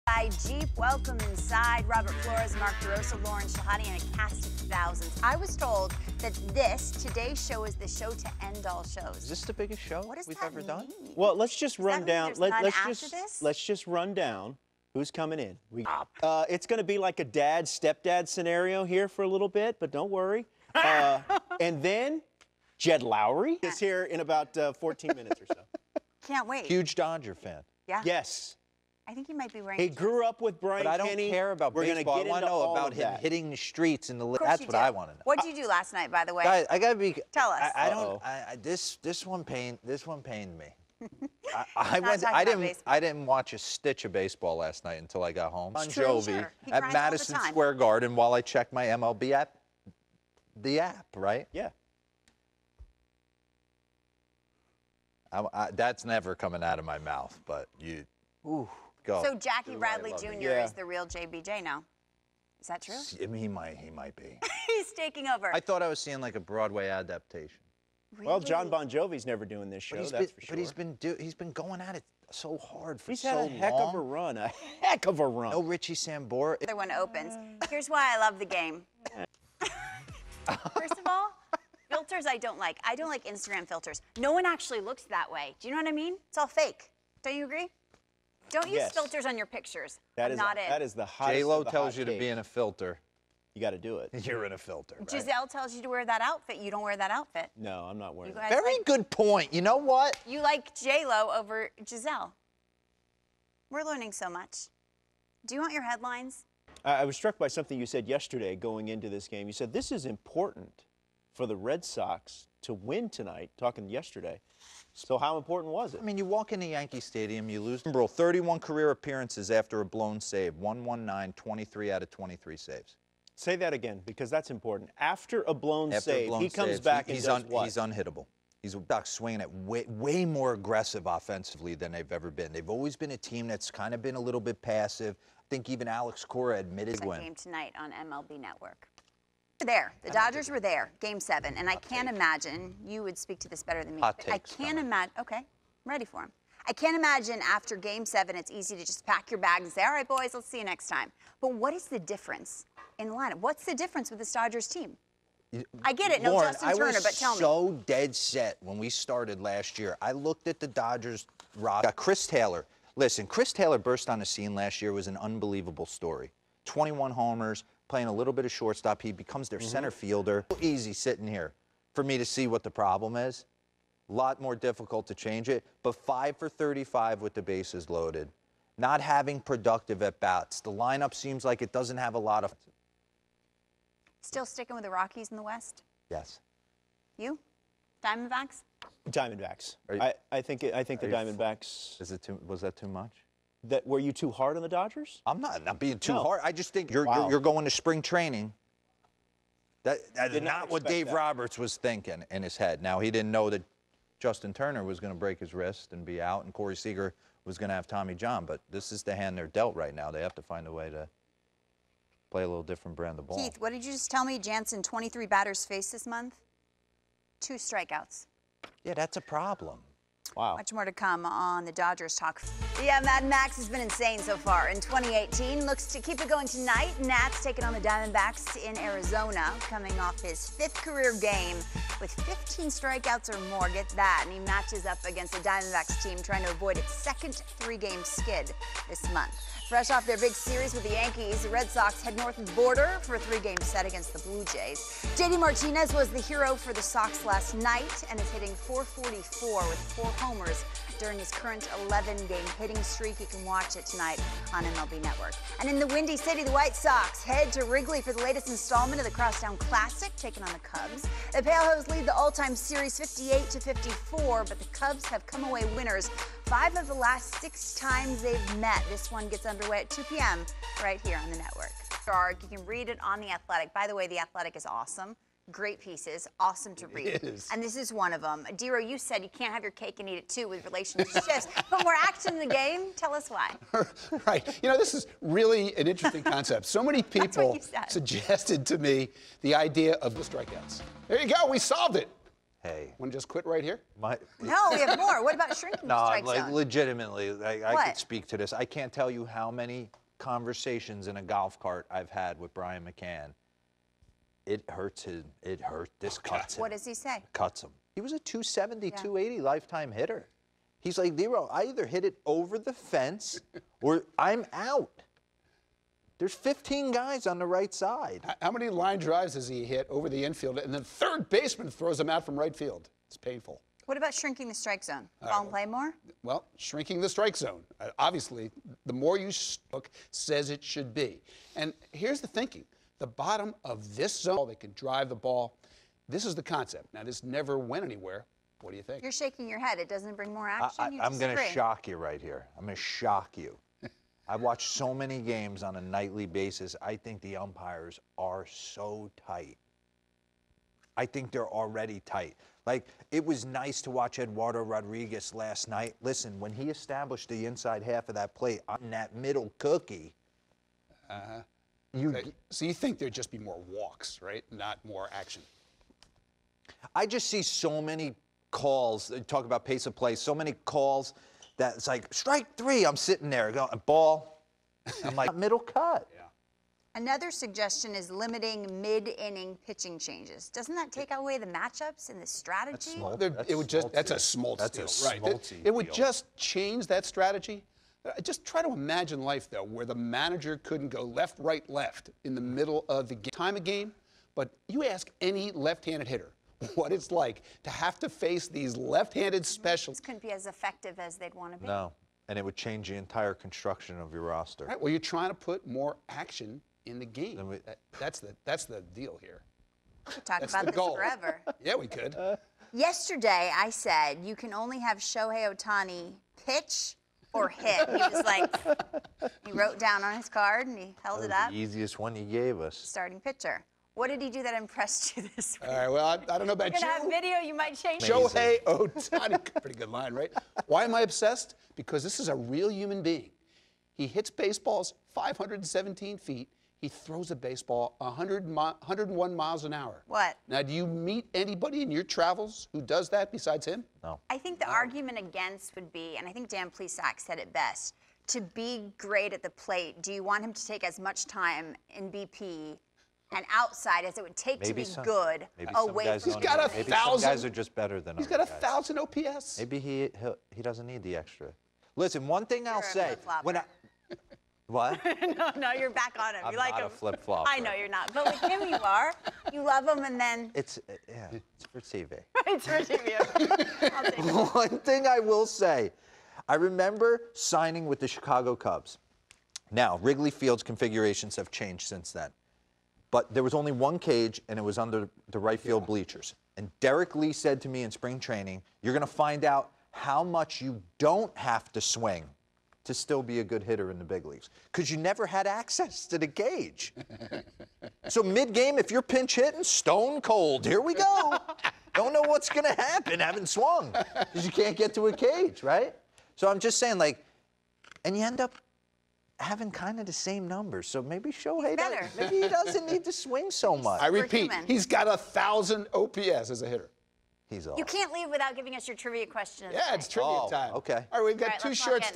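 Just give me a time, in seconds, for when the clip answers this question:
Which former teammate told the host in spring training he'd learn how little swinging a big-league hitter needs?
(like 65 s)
486 s.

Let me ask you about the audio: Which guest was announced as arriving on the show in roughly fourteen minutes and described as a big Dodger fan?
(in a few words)
Jed Lowry.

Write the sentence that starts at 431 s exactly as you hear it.
Because this is a real human being.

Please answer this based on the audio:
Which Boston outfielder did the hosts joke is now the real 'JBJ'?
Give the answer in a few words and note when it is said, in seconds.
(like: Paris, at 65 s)
Jackie Bradley Jr., at 59 s.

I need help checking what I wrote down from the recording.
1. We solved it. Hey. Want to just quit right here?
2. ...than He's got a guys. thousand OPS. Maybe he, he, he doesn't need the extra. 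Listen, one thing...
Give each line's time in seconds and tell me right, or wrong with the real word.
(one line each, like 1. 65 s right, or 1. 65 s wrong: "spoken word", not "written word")
1. 291 s right
2. 458 s right.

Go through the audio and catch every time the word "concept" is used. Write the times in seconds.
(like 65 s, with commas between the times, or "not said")
286 s, 336 s.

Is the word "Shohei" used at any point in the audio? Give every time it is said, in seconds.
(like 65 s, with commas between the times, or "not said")
414 s, 428 s, 511 s.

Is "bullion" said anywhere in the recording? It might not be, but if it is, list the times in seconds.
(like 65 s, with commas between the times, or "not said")
not said.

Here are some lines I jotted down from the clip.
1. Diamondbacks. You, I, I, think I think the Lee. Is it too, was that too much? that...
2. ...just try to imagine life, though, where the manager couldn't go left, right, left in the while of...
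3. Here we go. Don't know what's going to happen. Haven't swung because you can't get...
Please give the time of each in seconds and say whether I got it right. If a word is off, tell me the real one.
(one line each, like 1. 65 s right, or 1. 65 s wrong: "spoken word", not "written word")
1. 189 s wrong: "Diamondbacks", not "Lee"
2. 388 s wrong: "middle", not "while"
3. 500 s right.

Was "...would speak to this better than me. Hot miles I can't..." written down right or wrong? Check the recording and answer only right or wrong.
wrong.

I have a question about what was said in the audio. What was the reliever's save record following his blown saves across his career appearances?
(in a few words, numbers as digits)
23 out of 23.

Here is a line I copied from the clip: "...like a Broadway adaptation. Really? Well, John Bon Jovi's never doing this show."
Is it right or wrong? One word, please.
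right.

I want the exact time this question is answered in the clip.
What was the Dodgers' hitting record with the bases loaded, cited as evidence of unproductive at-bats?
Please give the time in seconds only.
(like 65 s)
176 s.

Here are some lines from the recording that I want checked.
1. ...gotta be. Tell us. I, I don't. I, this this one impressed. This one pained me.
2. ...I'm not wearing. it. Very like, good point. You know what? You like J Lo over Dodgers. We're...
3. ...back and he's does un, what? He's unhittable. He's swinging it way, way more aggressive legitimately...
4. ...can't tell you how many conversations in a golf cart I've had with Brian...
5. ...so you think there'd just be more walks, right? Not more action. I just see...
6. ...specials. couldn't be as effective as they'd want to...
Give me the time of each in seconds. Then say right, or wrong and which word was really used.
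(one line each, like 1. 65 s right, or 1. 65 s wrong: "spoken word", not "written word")
1. 36 s wrong: "pained", not "impressed"
2. 97 s wrong: "Giselle", not "Dodgers"
3. 126 s wrong: "offensively", not "legitimately"
4. 298 s right
5. 362 s right
6. 399 s right.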